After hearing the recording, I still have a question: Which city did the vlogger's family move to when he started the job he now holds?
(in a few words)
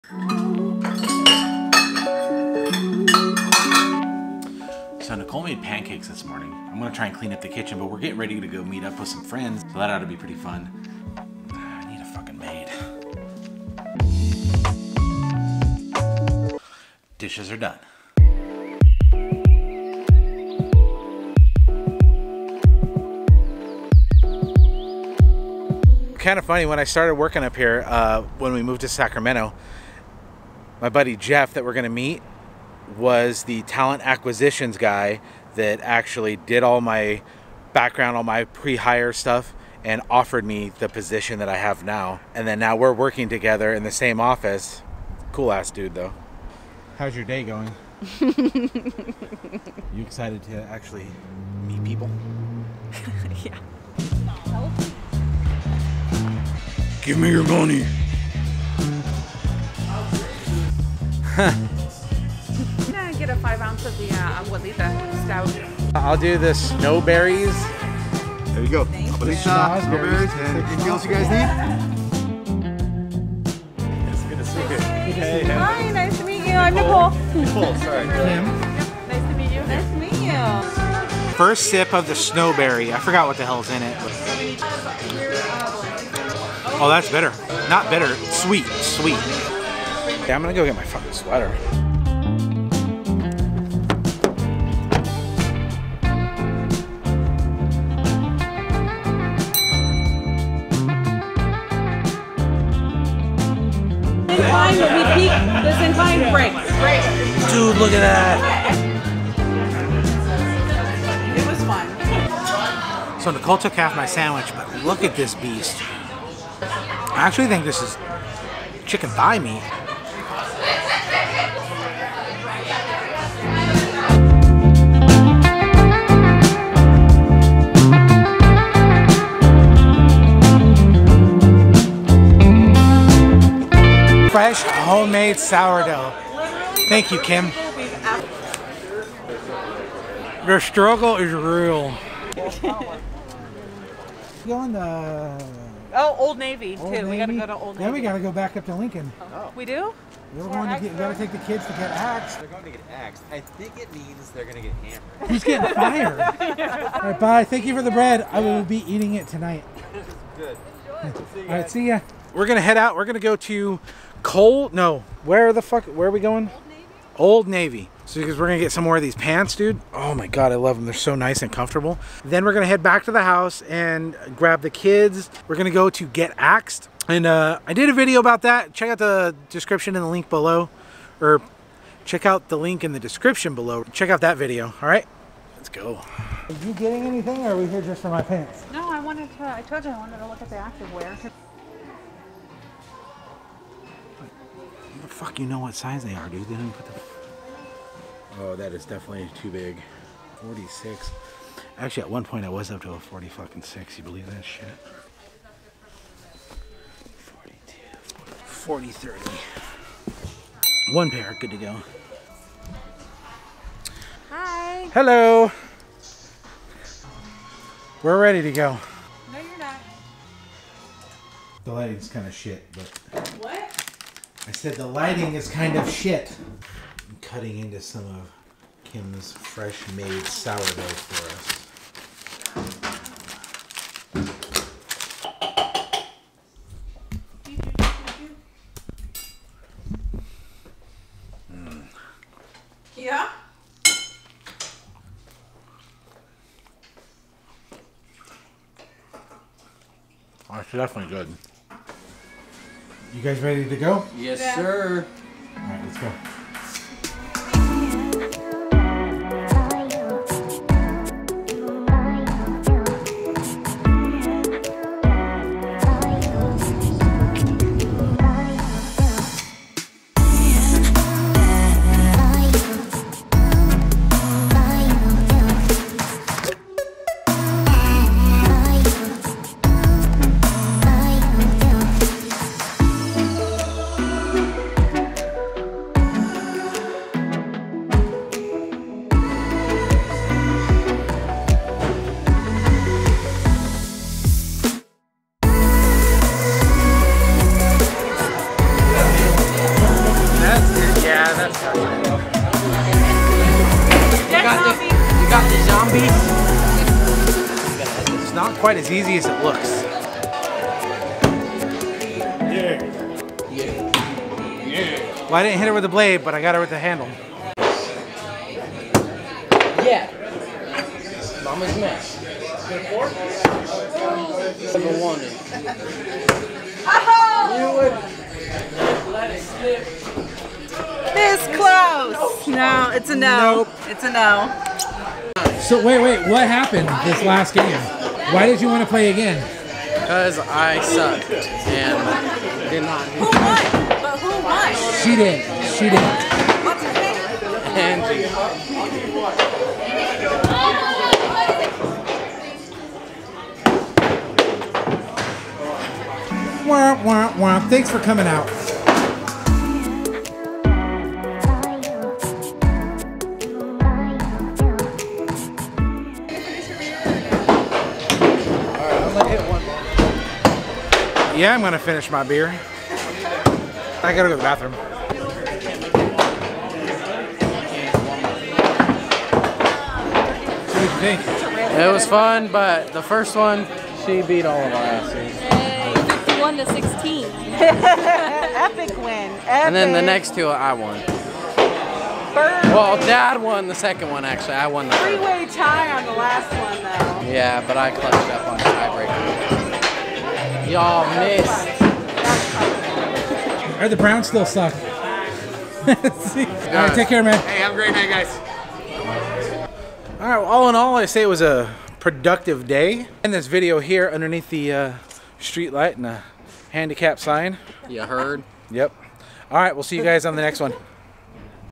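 Sacramento.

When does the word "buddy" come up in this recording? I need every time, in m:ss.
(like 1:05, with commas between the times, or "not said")
0:30.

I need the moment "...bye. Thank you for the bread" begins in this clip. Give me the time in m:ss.
2:37.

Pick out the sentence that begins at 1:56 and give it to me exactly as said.
I actually think this is chicken thigh meat.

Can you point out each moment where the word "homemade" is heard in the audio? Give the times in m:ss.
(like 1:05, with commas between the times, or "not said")
2:14.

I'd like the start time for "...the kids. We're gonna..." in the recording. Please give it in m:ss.
2:54.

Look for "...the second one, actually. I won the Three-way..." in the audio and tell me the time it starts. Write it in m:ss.
6:33.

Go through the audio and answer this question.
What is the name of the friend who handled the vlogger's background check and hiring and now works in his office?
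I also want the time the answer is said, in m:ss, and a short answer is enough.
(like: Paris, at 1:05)
Jeff, at 0:31.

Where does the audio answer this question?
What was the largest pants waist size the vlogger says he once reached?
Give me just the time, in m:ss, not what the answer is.
3:22.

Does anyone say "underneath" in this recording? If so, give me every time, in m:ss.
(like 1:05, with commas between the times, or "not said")
6:54.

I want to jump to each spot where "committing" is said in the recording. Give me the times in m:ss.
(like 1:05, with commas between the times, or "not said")
not said.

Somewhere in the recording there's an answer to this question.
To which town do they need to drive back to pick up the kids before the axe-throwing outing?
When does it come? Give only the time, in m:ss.
2:28.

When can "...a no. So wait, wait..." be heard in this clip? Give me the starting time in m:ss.
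5:34.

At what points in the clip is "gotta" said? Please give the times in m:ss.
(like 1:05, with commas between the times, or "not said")
2:30, 6:14.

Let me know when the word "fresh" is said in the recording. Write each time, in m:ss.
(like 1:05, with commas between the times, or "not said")
2:14, 3:49.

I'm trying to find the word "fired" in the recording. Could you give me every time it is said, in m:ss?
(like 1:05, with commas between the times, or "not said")
2:35.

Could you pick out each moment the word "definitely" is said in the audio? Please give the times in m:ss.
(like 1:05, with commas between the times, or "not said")
3:18, 4:10.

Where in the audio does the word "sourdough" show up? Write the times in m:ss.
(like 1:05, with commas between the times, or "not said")
2:15, 3:50.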